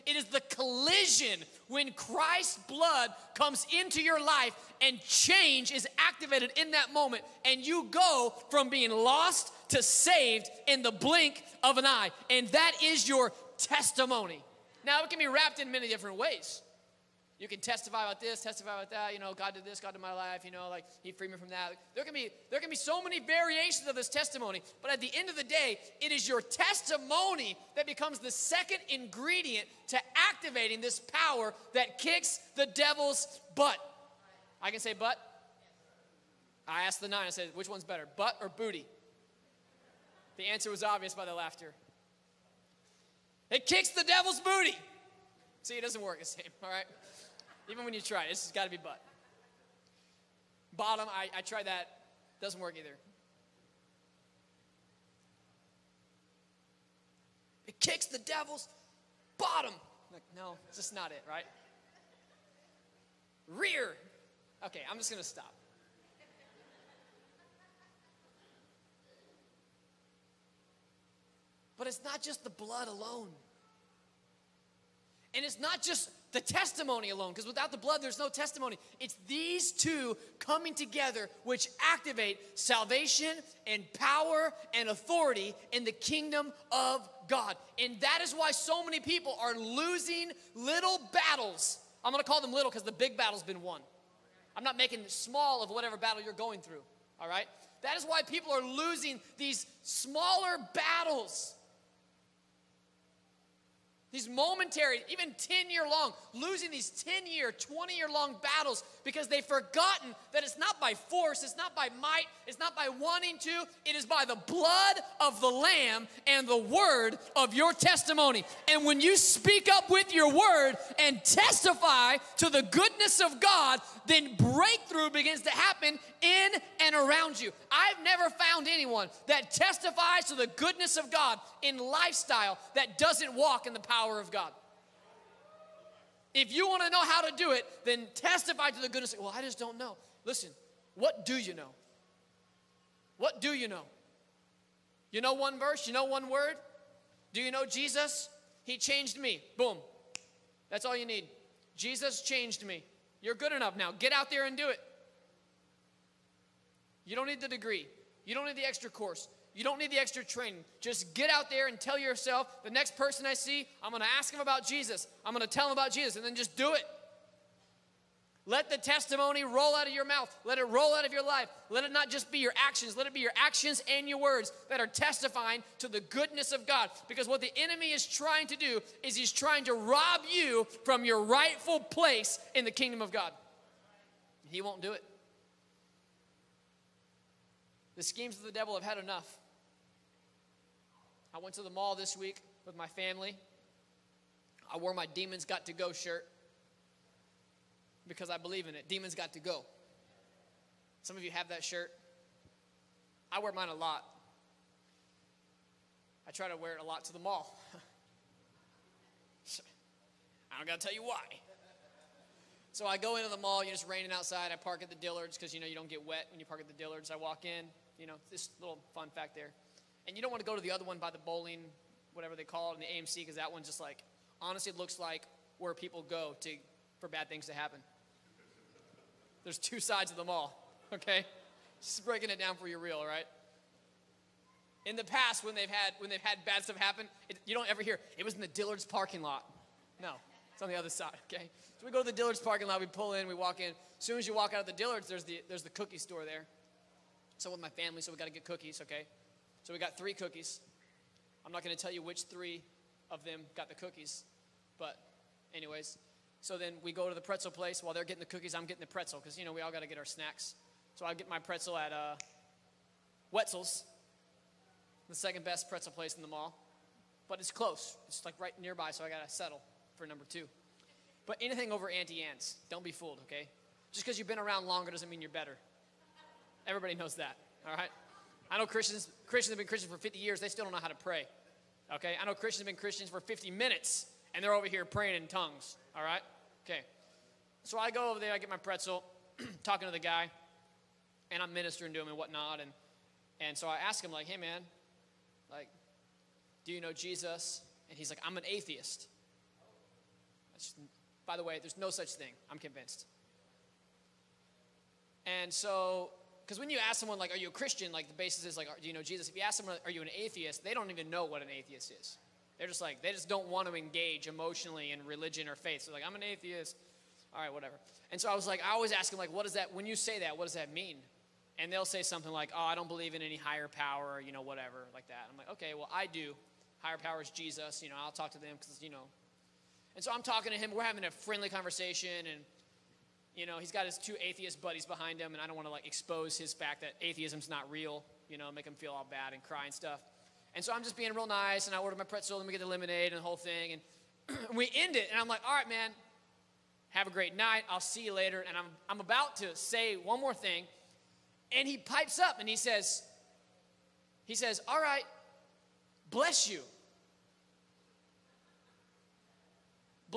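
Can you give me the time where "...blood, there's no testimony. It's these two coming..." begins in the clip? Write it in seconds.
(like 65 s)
77 s.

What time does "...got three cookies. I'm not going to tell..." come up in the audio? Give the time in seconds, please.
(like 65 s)
249 s.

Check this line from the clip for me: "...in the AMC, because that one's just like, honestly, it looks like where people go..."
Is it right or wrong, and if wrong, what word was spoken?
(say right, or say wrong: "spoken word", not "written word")
right.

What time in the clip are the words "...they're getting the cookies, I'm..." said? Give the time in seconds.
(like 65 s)
257 s.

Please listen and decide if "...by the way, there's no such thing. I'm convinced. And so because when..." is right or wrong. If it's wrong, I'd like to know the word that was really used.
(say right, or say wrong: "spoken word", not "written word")
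right.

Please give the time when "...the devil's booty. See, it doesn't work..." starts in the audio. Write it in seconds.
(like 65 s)
43 s.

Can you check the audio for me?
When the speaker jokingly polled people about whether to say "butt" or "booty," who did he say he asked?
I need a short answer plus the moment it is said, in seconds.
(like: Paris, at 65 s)
The nine, at 37 s.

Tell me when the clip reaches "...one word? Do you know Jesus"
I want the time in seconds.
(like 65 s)
146 s.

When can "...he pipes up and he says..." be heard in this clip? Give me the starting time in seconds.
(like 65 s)
351 s.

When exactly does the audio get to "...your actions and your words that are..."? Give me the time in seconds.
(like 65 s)
173 s.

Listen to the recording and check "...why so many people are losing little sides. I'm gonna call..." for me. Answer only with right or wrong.
wrong.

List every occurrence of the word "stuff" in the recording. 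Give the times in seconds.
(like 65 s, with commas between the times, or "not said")
236 s, 339 s.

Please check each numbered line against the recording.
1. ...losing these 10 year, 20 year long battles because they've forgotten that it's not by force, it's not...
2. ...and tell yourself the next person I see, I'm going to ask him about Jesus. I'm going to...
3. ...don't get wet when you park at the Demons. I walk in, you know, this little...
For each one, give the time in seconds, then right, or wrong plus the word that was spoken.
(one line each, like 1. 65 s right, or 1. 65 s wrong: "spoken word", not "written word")
1. 106 s right
2. 161 s right
3. 215 s wrong: "Dillards", not "Demons".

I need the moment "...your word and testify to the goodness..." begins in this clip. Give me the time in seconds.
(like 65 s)
120 s.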